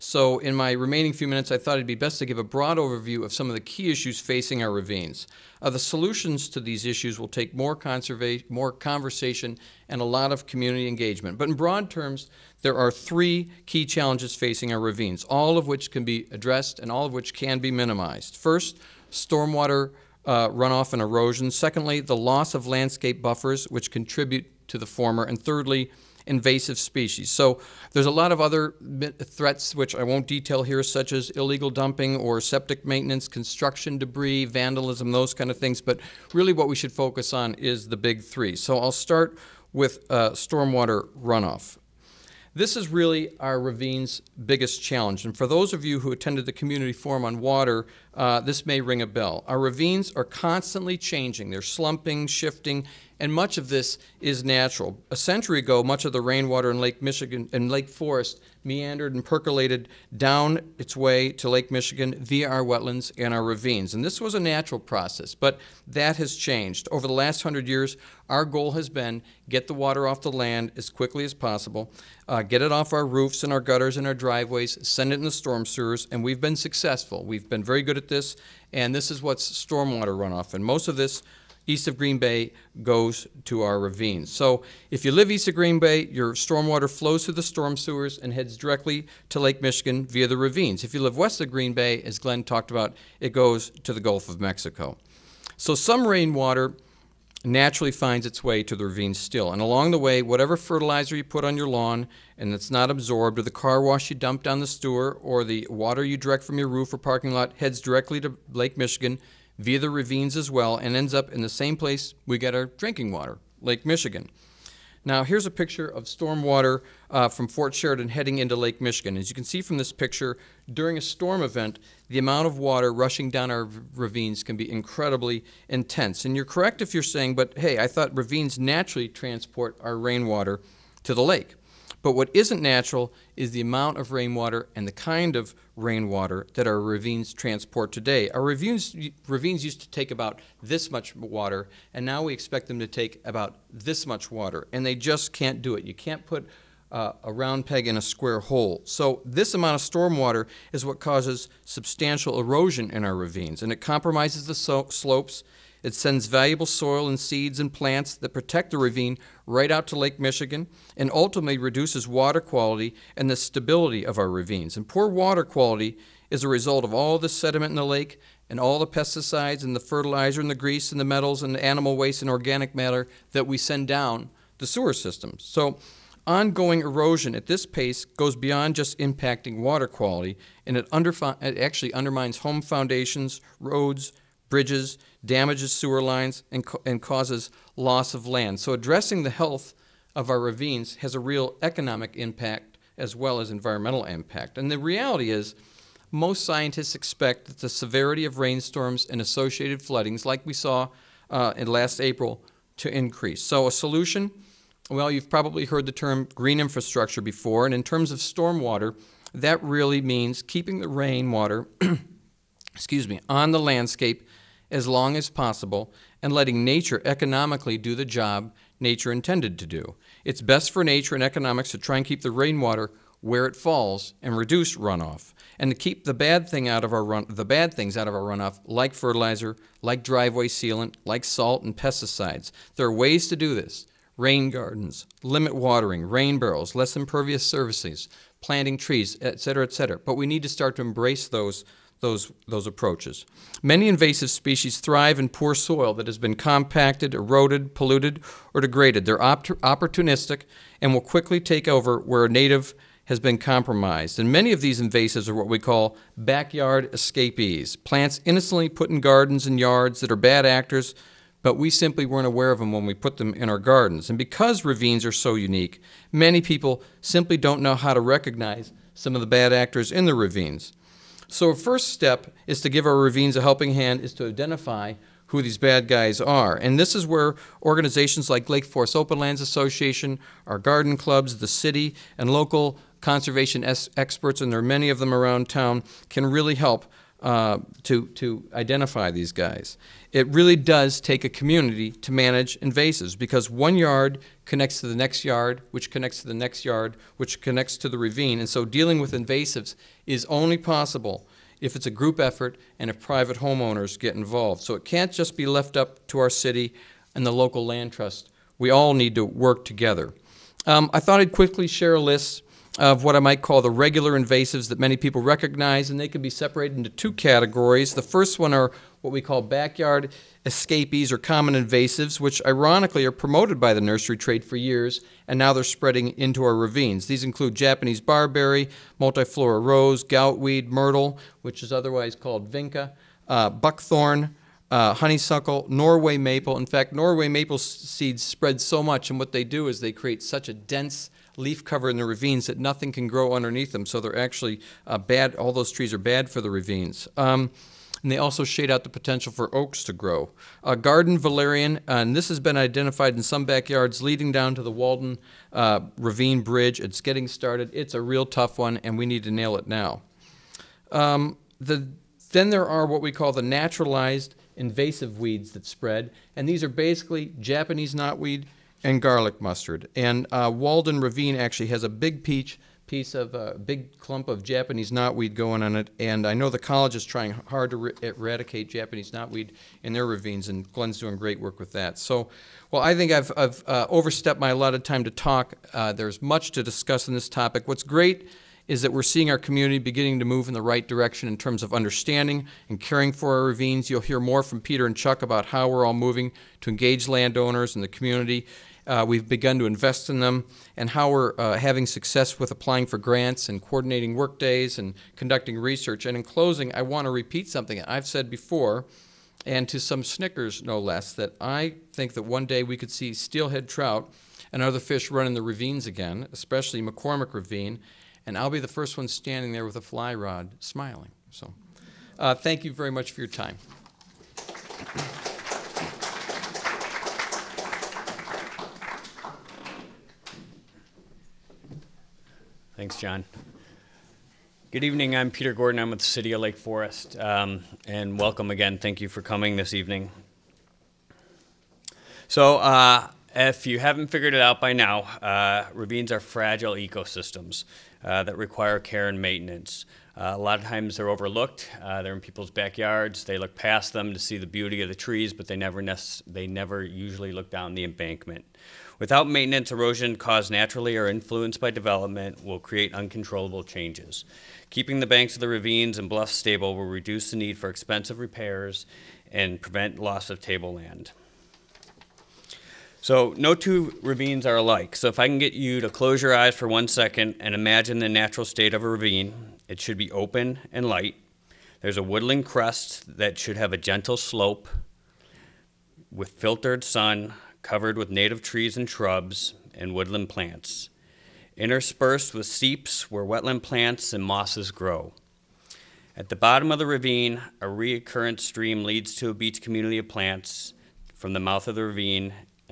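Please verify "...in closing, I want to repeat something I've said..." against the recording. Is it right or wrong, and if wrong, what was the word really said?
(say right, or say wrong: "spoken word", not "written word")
right.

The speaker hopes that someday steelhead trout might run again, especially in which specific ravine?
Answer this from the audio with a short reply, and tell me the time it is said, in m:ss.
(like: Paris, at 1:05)
McCormick Ravine, at 6:56.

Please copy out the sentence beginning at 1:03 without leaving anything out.
And this was a natural process, but that has changed.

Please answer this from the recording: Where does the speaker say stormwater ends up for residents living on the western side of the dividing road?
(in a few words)
Gulf of Mexico.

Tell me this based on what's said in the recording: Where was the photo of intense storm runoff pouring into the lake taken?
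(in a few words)
Fort Sheridan.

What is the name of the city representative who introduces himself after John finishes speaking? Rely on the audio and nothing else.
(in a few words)
Peter Gordon.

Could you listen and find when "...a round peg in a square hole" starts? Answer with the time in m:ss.
2:27.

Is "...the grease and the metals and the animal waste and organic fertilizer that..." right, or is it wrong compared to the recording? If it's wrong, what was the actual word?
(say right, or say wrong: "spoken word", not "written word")
wrong: "matter", not "fertilizer".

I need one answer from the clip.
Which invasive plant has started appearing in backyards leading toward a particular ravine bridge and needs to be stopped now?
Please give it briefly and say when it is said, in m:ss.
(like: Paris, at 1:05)
garden valerian, at 5:50.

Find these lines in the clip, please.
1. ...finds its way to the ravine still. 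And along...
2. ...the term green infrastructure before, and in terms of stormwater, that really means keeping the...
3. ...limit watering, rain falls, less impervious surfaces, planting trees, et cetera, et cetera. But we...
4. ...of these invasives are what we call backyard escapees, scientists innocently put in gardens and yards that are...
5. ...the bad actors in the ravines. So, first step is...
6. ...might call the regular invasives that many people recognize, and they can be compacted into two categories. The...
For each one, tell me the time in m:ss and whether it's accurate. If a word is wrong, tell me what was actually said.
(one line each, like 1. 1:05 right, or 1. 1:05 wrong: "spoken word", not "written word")
1. 1:37 right
2. 3:25 right
3. 3:55 wrong: "barrels", not "falls"
4. 4:14 wrong: "plants", not "scientists"
5. 4:29 right
6. 5:13 wrong: "separated", not "compacted".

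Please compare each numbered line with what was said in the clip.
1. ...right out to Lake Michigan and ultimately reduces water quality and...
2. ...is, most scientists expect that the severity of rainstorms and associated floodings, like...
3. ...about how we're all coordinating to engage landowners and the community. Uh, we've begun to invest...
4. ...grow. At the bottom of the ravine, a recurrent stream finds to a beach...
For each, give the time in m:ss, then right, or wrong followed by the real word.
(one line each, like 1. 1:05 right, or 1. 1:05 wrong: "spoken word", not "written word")
1. 2:39 right
2. 3:15 right
3. 6:35 wrong: "moving", not "coordinating"
4. 8:14 wrong: "leads", not "finds".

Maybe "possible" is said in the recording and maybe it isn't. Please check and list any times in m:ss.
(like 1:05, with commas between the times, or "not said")
1:11, 3:35, 5:00.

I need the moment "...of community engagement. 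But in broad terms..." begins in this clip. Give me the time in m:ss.
0:10.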